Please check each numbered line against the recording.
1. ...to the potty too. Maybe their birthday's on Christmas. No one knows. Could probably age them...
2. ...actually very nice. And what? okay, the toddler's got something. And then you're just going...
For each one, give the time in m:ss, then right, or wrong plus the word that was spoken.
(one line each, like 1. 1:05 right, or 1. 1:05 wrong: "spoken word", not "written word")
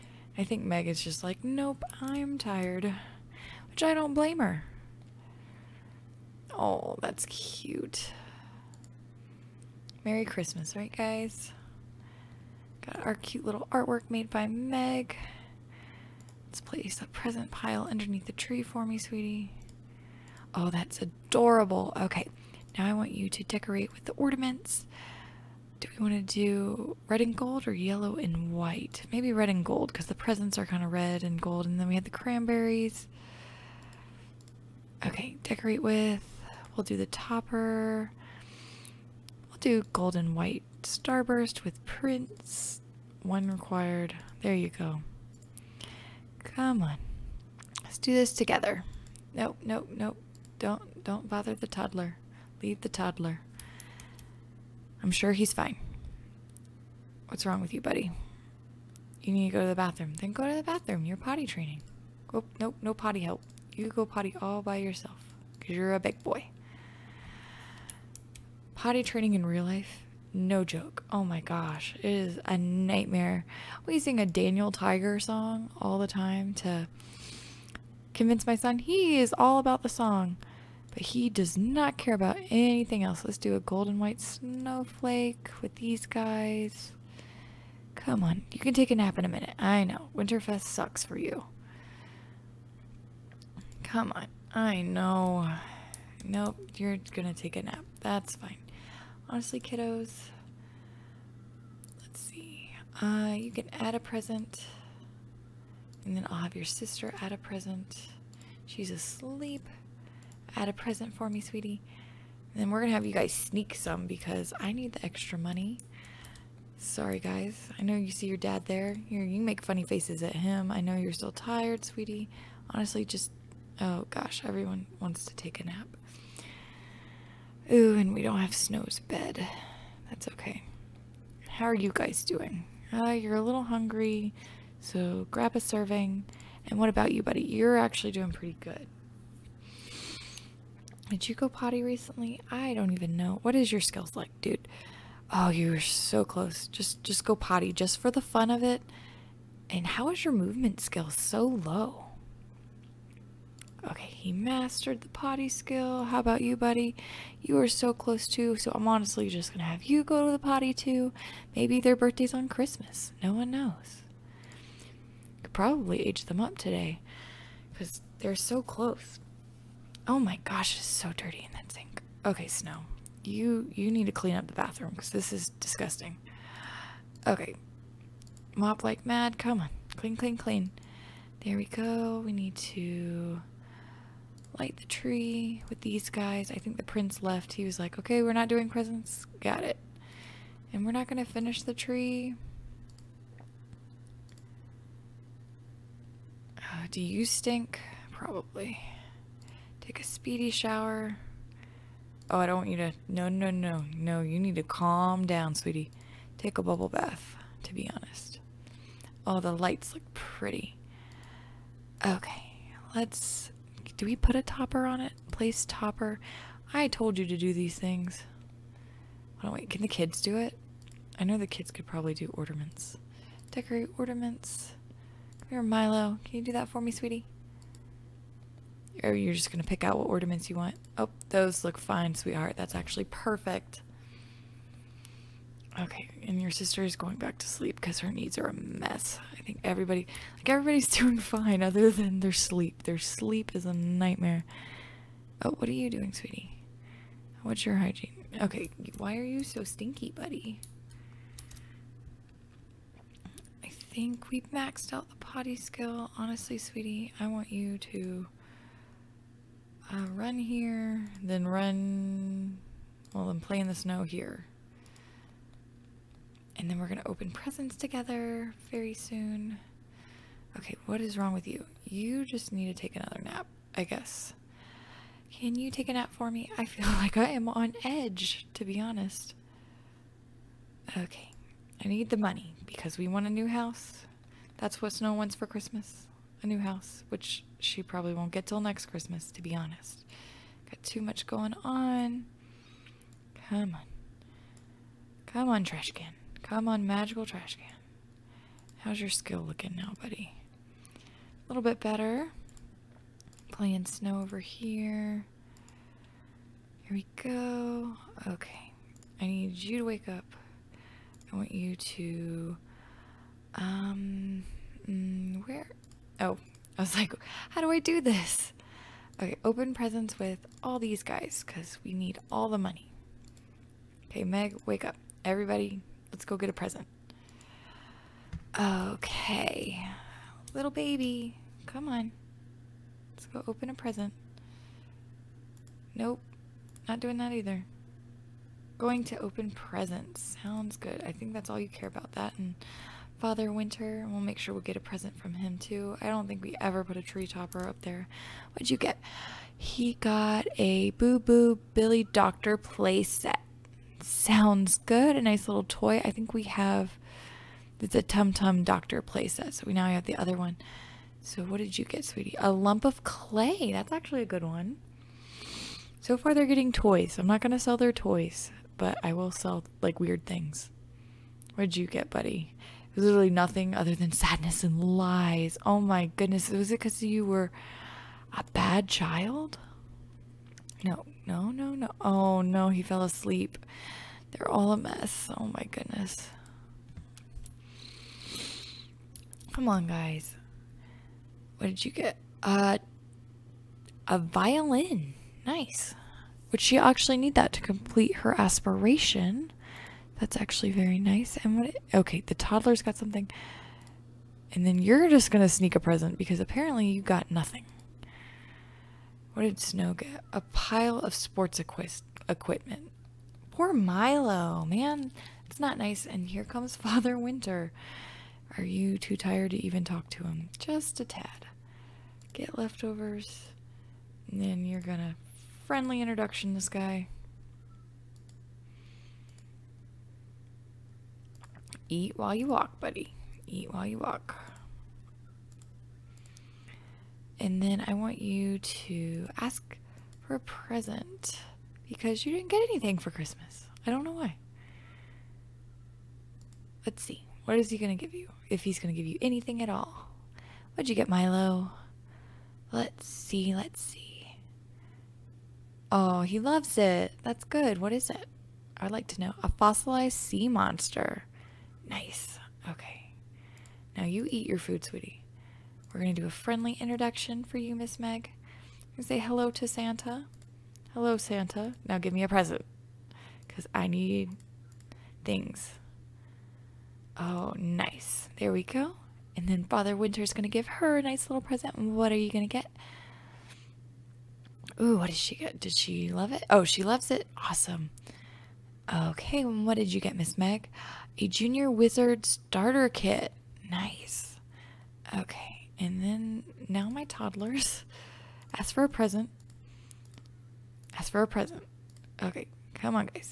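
1. 2:40 right
2. 6:40 right.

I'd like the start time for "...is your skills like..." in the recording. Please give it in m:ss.
2:23.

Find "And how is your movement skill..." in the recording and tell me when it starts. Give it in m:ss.
2:29.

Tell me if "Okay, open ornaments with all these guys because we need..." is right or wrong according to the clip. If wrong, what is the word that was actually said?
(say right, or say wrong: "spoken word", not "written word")
wrong: "presents", not "ornaments".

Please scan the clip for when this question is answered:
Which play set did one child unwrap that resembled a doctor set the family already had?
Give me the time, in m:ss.
5:50.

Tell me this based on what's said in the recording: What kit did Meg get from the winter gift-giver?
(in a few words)
Junior Wizard Starter Kit.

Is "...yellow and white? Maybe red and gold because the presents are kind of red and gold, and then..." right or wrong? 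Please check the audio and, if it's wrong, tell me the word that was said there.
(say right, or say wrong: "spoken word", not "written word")
right.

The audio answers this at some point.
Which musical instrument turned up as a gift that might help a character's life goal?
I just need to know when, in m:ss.
6:34.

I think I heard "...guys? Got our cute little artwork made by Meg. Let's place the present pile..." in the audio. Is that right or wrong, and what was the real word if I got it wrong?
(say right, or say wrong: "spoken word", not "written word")
right.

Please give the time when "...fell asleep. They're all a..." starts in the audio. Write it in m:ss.
6:22.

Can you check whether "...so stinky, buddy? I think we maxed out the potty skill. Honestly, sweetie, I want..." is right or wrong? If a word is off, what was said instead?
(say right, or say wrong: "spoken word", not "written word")
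right.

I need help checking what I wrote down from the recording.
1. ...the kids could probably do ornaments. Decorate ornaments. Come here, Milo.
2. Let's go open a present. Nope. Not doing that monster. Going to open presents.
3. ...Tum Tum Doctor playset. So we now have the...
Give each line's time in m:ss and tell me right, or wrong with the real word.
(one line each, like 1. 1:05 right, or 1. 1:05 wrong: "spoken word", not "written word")
1. 3:41 right
2. 5:33 wrong: "either", not "monster"
3. 5:58 right.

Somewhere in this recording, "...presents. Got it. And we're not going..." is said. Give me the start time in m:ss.
3:08.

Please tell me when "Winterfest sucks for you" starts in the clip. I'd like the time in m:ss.
1:30.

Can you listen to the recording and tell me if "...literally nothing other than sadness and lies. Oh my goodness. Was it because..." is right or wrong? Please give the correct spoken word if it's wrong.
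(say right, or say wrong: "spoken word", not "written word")
right.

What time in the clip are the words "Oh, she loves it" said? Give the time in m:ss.
8:06.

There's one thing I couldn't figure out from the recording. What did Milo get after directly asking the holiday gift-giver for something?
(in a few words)
A fossilized sea monster.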